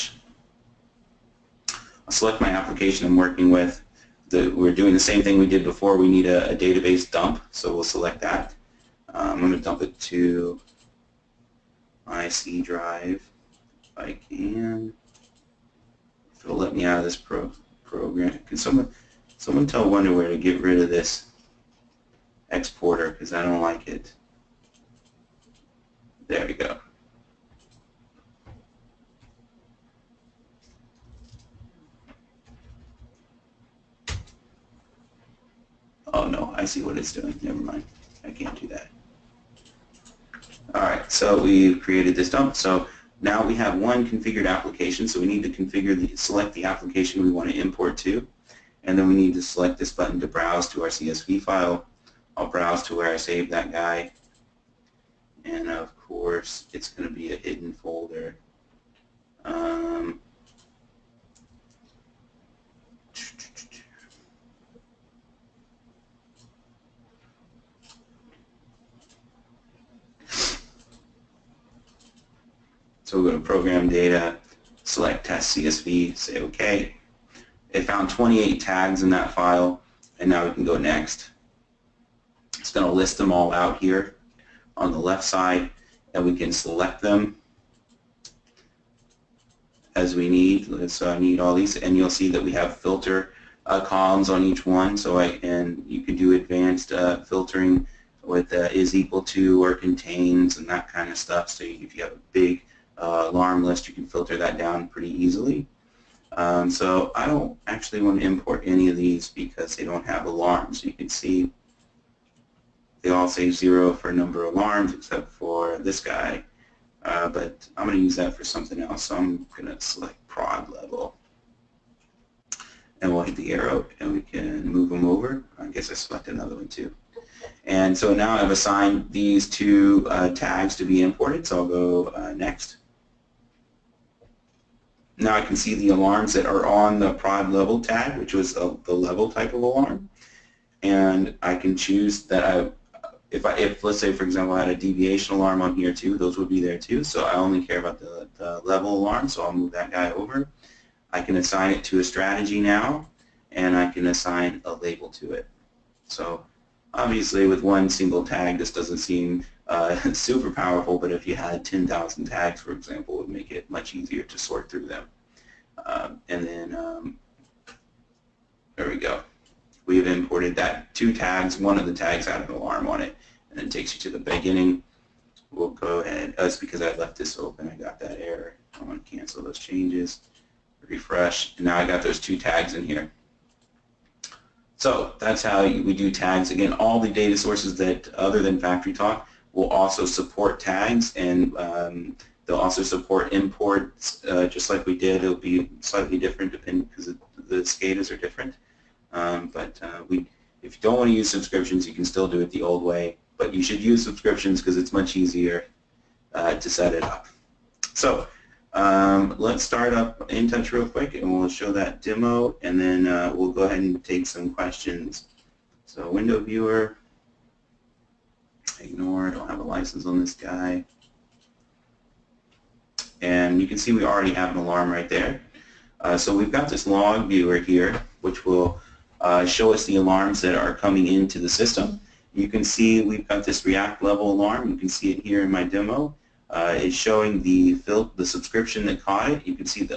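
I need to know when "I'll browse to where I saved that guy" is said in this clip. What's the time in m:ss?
0:52.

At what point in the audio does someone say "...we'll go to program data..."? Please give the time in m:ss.
1:13.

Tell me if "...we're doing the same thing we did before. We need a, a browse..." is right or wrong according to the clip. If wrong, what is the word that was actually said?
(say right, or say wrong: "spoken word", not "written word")
wrong: "database", not "browse".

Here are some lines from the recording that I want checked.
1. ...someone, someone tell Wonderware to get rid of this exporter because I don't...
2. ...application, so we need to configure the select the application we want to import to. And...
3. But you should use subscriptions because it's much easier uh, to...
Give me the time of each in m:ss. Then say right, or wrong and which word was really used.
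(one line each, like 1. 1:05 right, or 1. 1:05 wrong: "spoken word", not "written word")
1. 0:18 right
2. 0:44 right
3. 3:23 right.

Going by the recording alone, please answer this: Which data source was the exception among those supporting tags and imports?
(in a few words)
FactoryTalk.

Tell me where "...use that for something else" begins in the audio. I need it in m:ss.
1:58.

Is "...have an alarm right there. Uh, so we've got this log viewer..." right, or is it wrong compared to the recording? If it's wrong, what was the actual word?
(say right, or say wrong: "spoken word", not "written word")
right.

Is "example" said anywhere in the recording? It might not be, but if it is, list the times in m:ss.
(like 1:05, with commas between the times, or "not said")
2:24, 2:42.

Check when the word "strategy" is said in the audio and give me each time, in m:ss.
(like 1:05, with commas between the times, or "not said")
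2:32.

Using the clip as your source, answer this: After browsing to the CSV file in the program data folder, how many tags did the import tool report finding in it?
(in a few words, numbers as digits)
28.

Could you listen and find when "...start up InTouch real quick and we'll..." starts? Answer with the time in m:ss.
3:29.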